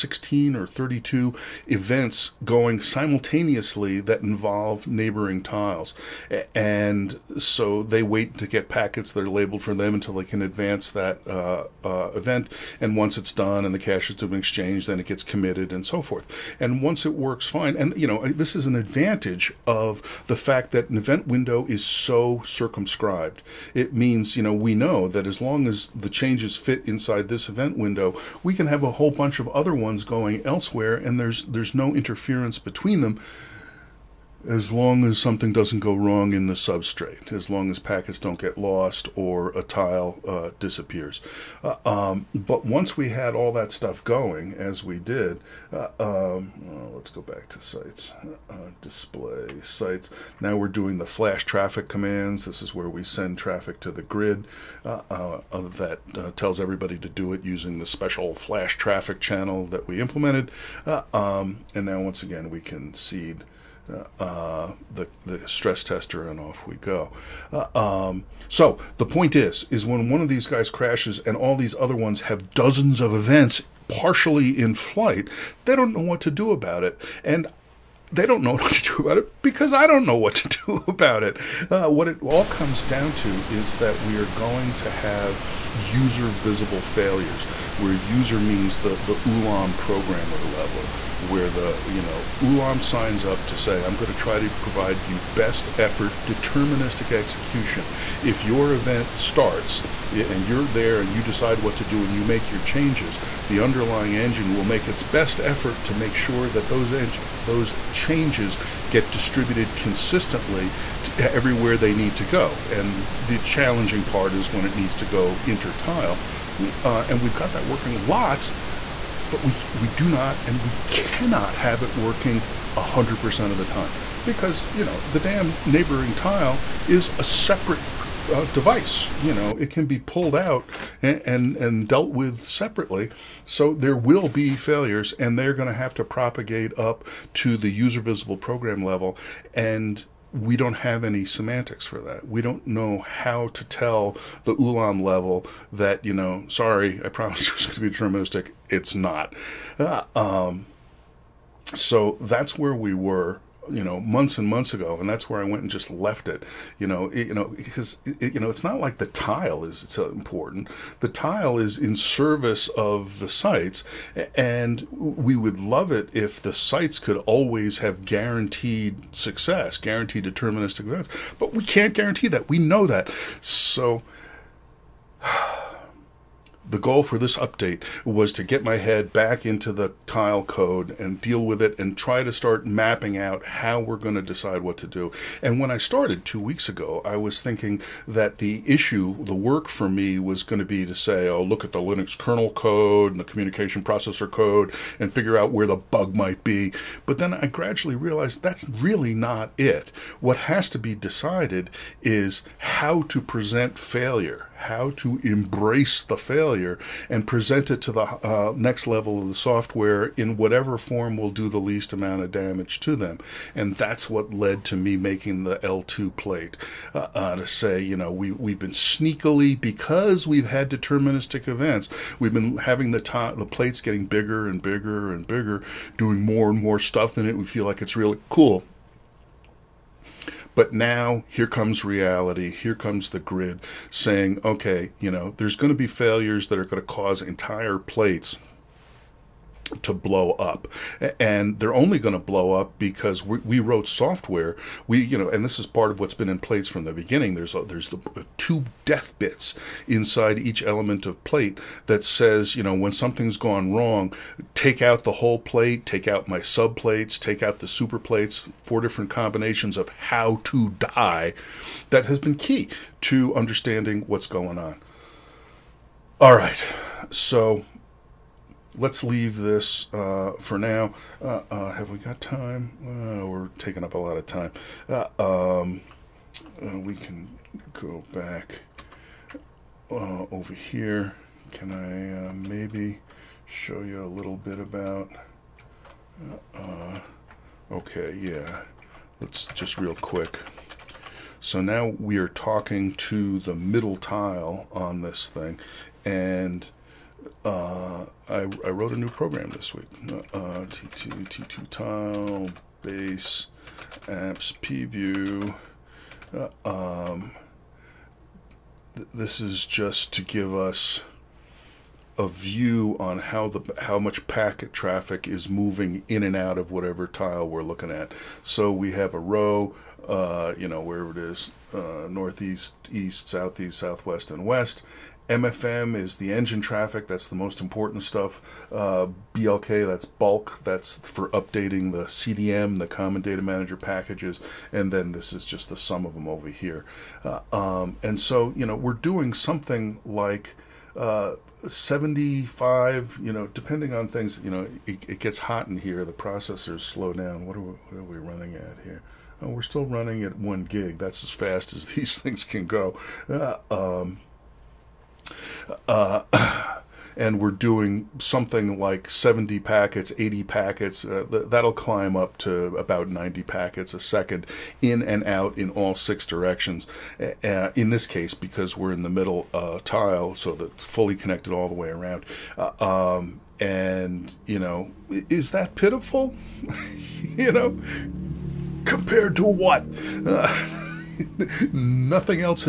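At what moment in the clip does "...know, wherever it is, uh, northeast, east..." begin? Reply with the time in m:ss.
5:20.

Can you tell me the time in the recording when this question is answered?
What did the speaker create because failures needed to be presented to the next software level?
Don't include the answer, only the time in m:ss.
3:35.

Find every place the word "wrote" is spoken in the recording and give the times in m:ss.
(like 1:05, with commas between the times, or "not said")
4:03, 4:58.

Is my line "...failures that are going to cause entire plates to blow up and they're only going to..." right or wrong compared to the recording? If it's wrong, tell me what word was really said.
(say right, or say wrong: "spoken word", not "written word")
right.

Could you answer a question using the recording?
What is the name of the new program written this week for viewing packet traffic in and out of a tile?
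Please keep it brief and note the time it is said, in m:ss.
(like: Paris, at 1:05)
pview, at 5:04.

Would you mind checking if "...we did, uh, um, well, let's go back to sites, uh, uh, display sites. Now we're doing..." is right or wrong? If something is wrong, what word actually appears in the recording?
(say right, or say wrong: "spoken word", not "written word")
right.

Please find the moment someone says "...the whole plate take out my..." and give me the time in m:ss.
4:15.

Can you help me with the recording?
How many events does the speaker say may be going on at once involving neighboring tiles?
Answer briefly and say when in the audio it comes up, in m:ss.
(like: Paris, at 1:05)
32, at 0:00.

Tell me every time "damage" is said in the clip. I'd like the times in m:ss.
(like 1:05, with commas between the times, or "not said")
3:32.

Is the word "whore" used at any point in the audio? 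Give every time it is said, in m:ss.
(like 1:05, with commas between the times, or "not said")
not said.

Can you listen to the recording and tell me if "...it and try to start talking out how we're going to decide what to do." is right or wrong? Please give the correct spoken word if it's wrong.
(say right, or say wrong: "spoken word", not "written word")
wrong: "mapping", not "talking".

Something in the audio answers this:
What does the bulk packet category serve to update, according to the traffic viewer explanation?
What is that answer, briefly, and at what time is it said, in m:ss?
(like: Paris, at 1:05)
Common Data Manager, at 5:32.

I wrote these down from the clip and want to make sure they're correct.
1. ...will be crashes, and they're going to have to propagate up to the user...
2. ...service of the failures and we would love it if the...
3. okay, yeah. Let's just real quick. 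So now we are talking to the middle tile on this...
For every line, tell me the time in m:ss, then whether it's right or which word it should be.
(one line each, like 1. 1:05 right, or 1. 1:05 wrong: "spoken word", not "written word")
1. 2:13 wrong: "failures", not "crashes"
2. 2:41 wrong: "sites", not "failures"
3. 4:47 right.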